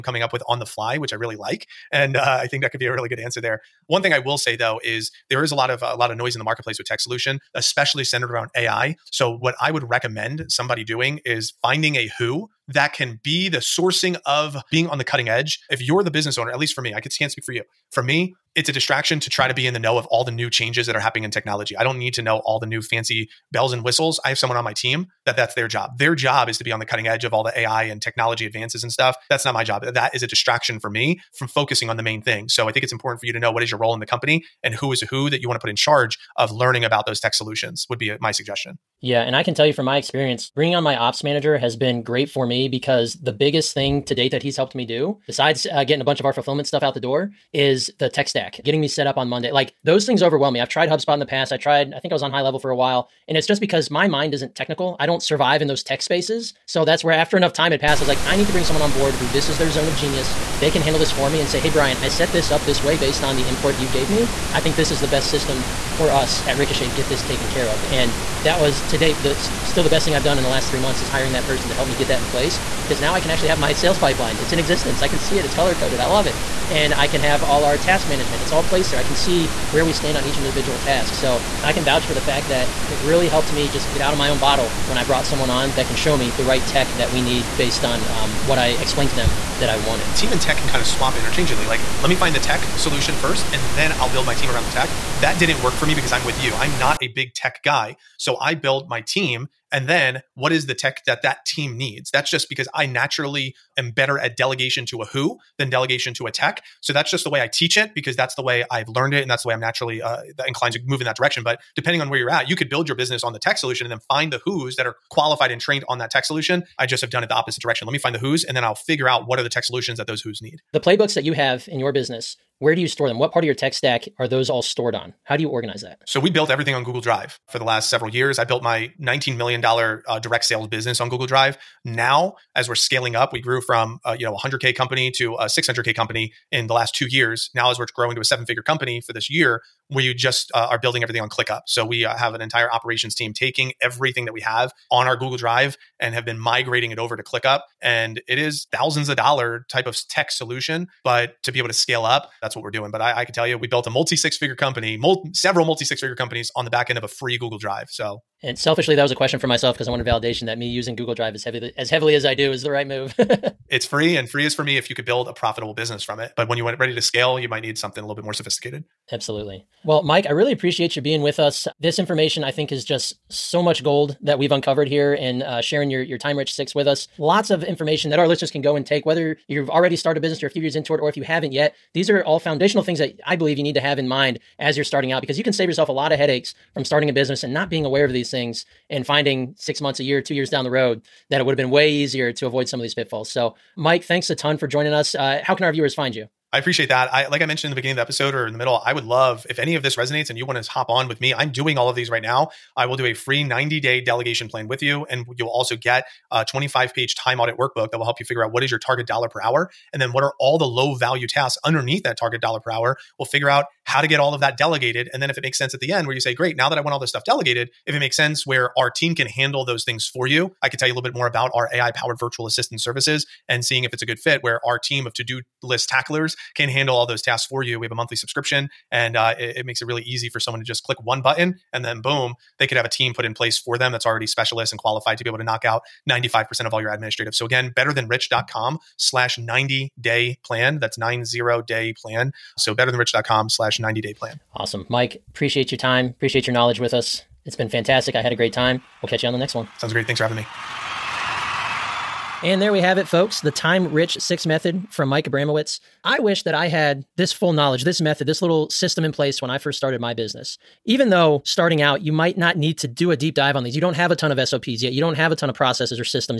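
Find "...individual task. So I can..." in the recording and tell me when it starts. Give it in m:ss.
1:20.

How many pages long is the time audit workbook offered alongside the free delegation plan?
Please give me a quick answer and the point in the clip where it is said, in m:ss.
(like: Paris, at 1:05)
25, at 3:26.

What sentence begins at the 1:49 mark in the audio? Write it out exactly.
And that's the way I'm naturally uh, inclined to move in that direction.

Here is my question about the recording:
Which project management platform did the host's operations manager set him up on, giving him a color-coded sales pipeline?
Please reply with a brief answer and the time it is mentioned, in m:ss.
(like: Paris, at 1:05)
Monday, at 0:49.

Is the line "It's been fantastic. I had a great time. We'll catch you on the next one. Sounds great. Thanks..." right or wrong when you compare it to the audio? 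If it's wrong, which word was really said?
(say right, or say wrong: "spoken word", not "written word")
right.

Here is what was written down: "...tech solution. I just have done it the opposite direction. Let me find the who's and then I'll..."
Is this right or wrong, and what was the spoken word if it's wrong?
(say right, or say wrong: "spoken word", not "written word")
right.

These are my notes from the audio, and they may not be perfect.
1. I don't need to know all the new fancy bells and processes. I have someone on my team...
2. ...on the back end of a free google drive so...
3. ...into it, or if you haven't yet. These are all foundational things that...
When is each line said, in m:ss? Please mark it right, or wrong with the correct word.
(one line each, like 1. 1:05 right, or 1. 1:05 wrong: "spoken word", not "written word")
1. 0:21 wrong: "whistles", not "processes"
2. 2:36 right
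3. 3:00 right.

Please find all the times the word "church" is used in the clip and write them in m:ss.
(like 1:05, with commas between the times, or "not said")
not said.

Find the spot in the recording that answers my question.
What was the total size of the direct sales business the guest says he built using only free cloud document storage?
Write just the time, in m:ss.
2:09.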